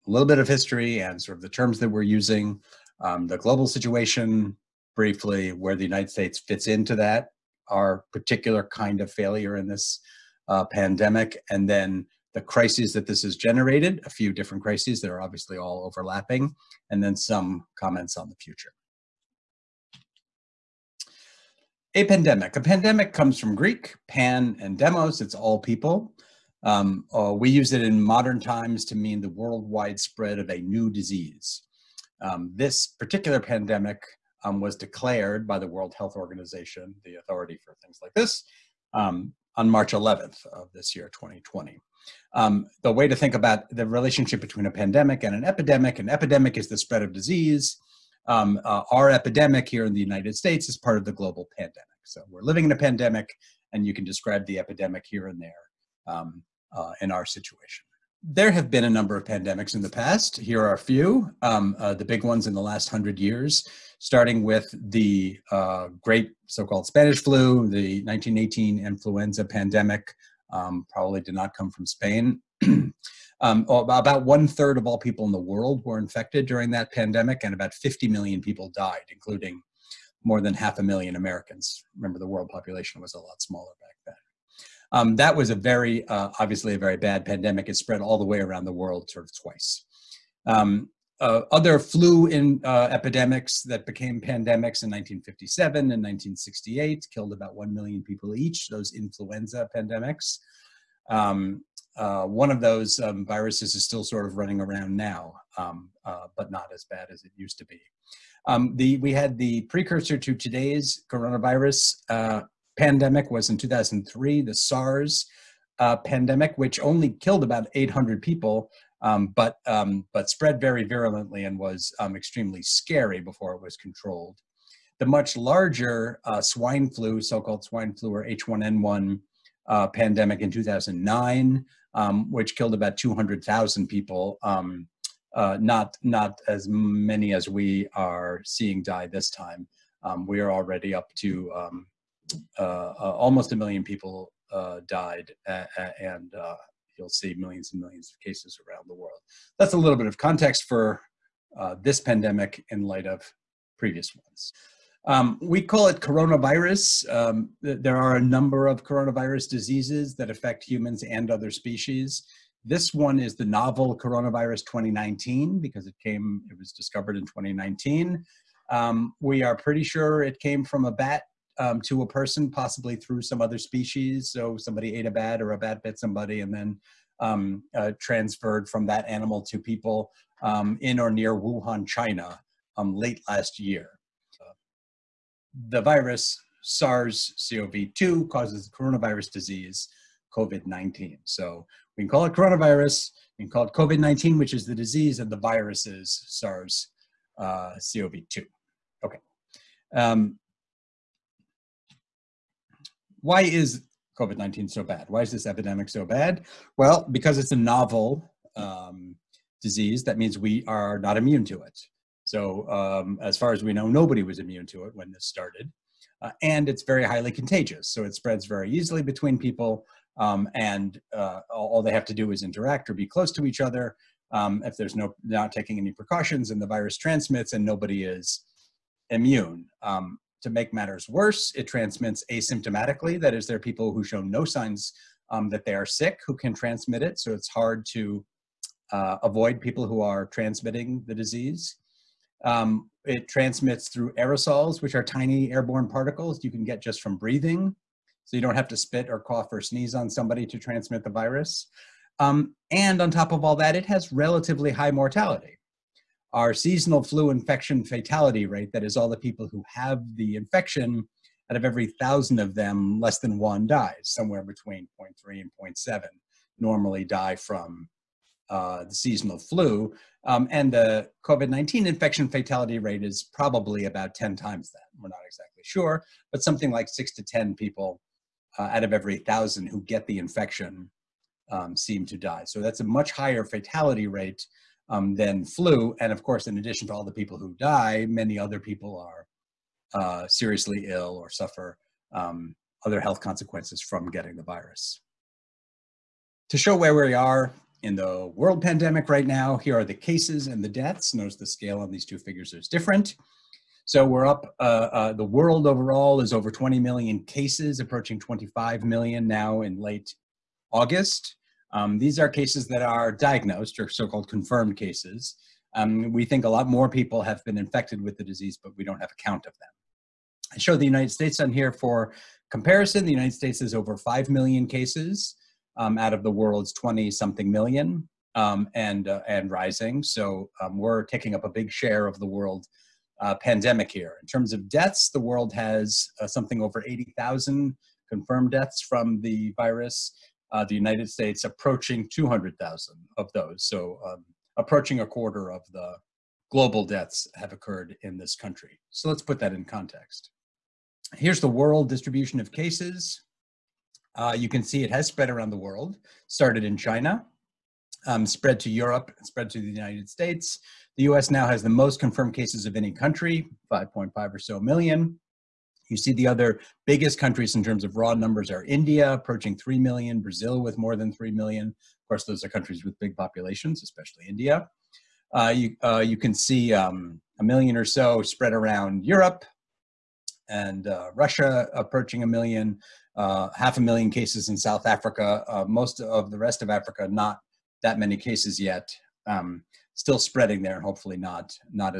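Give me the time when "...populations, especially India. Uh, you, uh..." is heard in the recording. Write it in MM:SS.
06:13.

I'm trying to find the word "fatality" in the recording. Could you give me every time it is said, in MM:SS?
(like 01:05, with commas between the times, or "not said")
04:17, 04:32, 04:43.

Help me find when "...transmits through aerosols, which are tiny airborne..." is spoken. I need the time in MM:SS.
04:03.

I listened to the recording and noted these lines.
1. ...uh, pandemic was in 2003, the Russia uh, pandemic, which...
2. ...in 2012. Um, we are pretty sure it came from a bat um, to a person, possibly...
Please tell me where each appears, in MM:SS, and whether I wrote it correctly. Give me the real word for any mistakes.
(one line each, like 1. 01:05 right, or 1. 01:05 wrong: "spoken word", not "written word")
1. 01:52 wrong: "SARS", not "Russia"
2. 02:47 wrong: "2019", not "2012".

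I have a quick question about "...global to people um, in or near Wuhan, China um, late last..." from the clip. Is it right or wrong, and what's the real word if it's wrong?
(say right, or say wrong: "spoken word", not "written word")
wrong: "animal", not "global".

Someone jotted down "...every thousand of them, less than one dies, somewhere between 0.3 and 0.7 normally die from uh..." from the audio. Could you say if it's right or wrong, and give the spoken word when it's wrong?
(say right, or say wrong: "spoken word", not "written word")
right.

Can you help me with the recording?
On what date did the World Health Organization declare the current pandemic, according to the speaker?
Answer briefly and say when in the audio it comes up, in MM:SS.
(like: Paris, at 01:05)
March 11th, at 00:39.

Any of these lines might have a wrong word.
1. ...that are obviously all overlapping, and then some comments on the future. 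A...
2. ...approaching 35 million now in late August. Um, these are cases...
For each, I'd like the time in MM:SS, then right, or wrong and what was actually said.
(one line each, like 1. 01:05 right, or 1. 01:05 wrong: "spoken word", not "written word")
1. 00:15 right
2. 05:07 wrong: "25", not "35".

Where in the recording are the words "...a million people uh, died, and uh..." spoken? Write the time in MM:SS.
02:23.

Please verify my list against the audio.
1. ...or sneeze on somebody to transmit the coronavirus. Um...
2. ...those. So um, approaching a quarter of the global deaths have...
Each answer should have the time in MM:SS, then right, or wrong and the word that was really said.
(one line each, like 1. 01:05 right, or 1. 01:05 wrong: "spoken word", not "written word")
1. 04:09 wrong: "virus", not "coronavirus"
2. 05:43 right.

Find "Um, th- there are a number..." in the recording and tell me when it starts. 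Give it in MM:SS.
02:37.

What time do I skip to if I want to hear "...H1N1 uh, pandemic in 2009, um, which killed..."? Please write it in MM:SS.
02:08.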